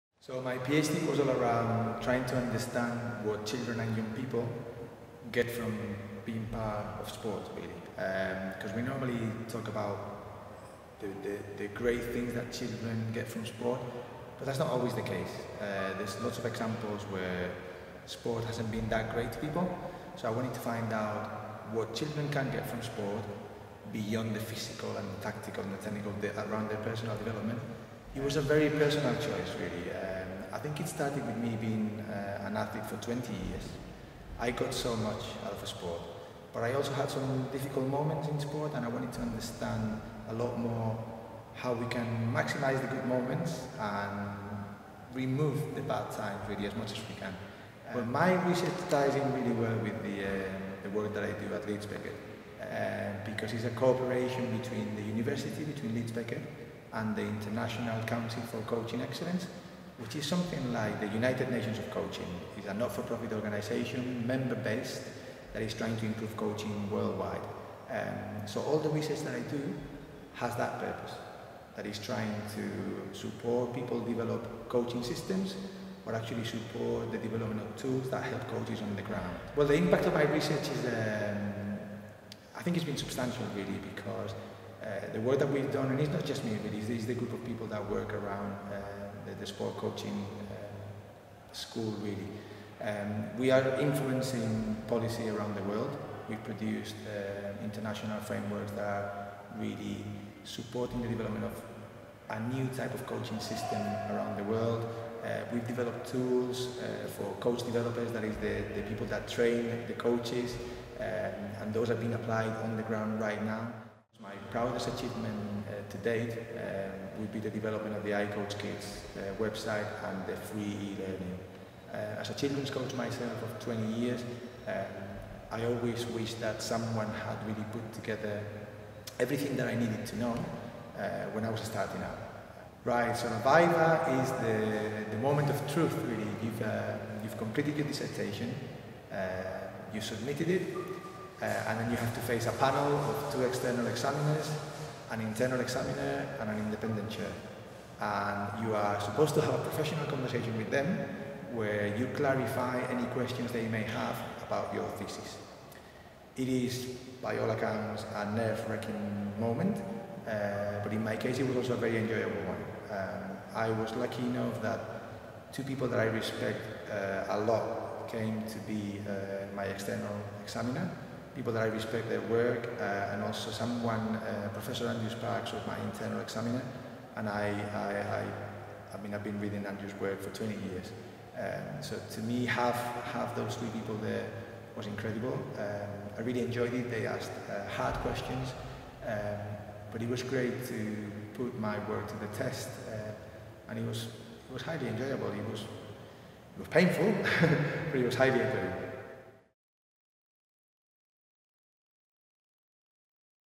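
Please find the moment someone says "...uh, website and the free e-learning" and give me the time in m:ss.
1:59.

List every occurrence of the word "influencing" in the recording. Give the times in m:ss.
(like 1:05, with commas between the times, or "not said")
1:33.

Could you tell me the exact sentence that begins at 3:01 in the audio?
Um, so to me, have, have those three people there was incredible.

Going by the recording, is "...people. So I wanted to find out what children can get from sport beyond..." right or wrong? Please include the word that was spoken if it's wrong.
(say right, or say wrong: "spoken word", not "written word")
right.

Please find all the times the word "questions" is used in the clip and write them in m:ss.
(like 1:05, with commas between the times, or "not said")
2:33, 3:07.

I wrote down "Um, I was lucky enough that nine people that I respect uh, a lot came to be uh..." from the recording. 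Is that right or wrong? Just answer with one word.
wrong.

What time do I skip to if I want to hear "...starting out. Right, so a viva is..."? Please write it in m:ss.
2:11.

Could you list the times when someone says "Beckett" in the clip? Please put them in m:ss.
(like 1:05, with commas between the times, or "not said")
0:51, 0:56.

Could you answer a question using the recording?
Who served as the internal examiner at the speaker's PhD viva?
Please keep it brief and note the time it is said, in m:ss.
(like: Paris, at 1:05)
Andrew Sparkes, at 2:54.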